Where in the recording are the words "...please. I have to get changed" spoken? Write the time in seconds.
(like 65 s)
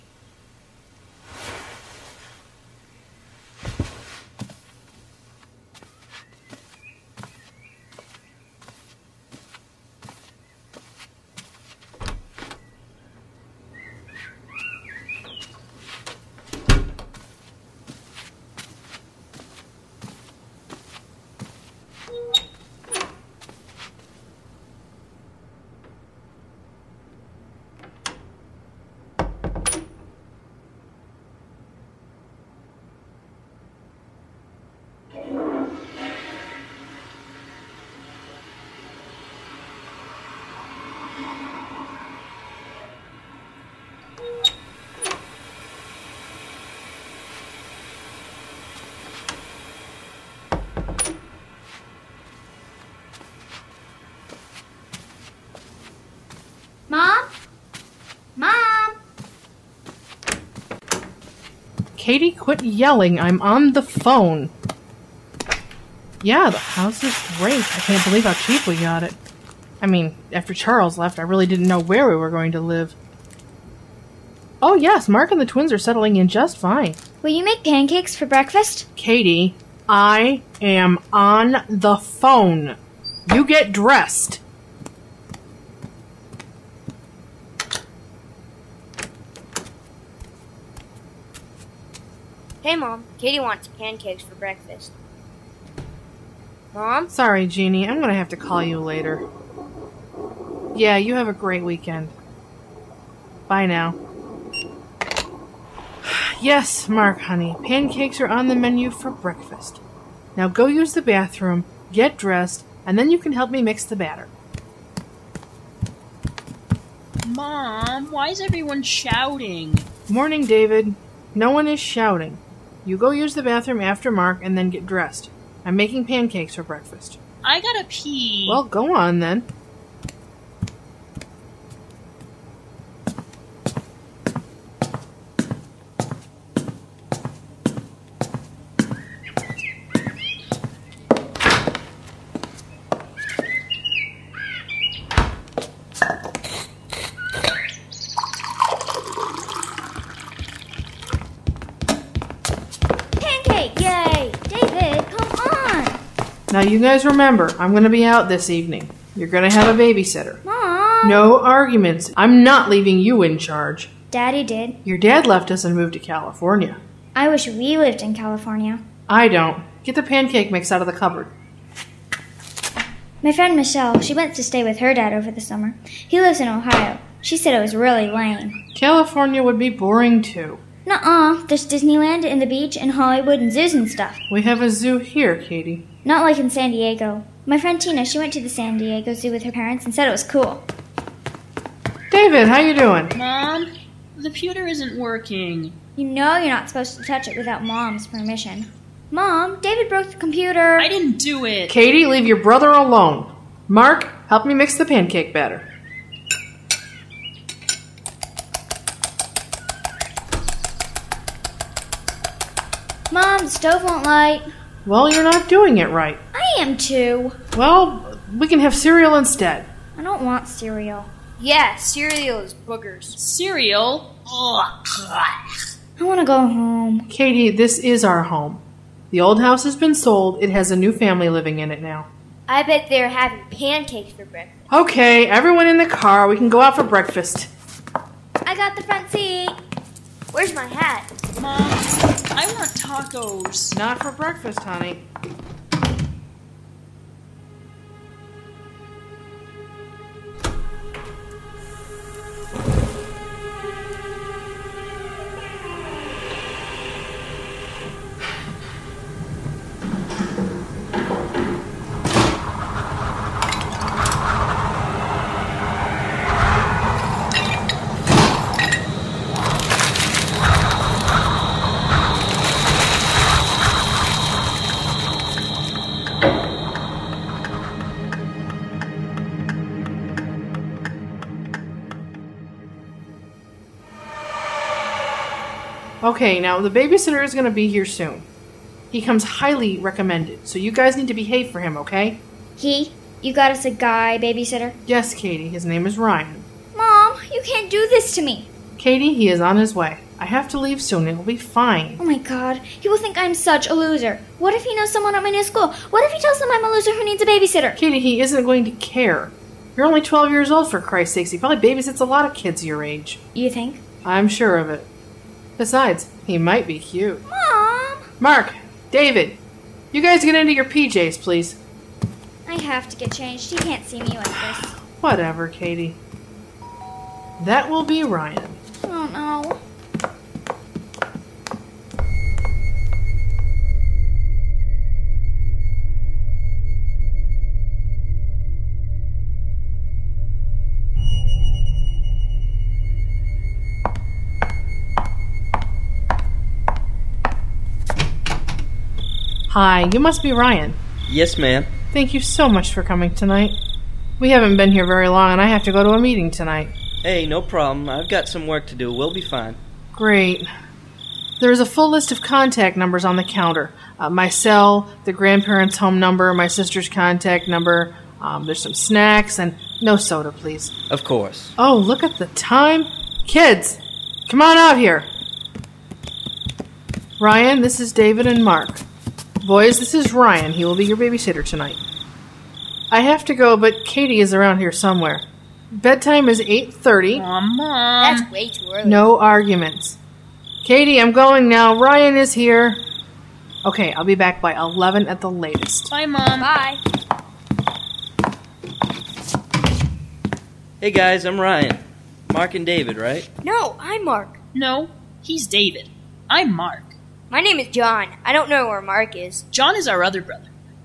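321 s.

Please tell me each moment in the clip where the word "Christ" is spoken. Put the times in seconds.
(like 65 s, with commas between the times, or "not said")
310 s.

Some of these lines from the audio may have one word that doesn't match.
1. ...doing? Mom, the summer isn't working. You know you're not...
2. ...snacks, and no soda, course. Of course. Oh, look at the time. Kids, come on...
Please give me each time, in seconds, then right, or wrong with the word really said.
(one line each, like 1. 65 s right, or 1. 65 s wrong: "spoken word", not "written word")
1. 192 s wrong: "pewter", not "summer"
2. 368 s wrong: "please", not "course".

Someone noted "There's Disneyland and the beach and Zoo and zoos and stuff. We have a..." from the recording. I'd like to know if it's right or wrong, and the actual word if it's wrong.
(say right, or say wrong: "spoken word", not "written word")
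wrong: "Hollywood", not "Zoo".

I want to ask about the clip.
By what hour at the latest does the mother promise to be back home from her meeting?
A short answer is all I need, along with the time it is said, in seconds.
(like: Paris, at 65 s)
11, at 394 s.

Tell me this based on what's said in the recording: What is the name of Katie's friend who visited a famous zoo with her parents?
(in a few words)
Tina.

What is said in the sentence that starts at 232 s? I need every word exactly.
I bet they're having pancakes for breakfast.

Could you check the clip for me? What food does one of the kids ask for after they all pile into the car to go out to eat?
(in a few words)
Tacos.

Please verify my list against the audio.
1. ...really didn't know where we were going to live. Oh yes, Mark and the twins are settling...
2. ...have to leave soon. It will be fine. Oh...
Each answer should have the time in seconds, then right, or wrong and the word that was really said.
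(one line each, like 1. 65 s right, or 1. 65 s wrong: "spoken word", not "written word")
1. 71 s right
2. 300 s right.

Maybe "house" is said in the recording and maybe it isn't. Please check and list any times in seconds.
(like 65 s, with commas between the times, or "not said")
66 s, 229 s.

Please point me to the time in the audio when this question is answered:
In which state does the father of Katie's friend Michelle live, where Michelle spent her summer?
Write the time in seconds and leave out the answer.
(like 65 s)
176 s.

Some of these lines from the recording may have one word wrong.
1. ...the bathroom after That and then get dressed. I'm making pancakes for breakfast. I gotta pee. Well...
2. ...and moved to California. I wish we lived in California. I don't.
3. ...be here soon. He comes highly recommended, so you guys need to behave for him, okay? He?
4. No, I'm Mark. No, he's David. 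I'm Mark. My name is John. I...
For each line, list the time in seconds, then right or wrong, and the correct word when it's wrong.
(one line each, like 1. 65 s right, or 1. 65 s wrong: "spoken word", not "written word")
1. 123 s wrong: "Mark", not "That"
2. 165 s right
3. 287 s right
4. 403 s right.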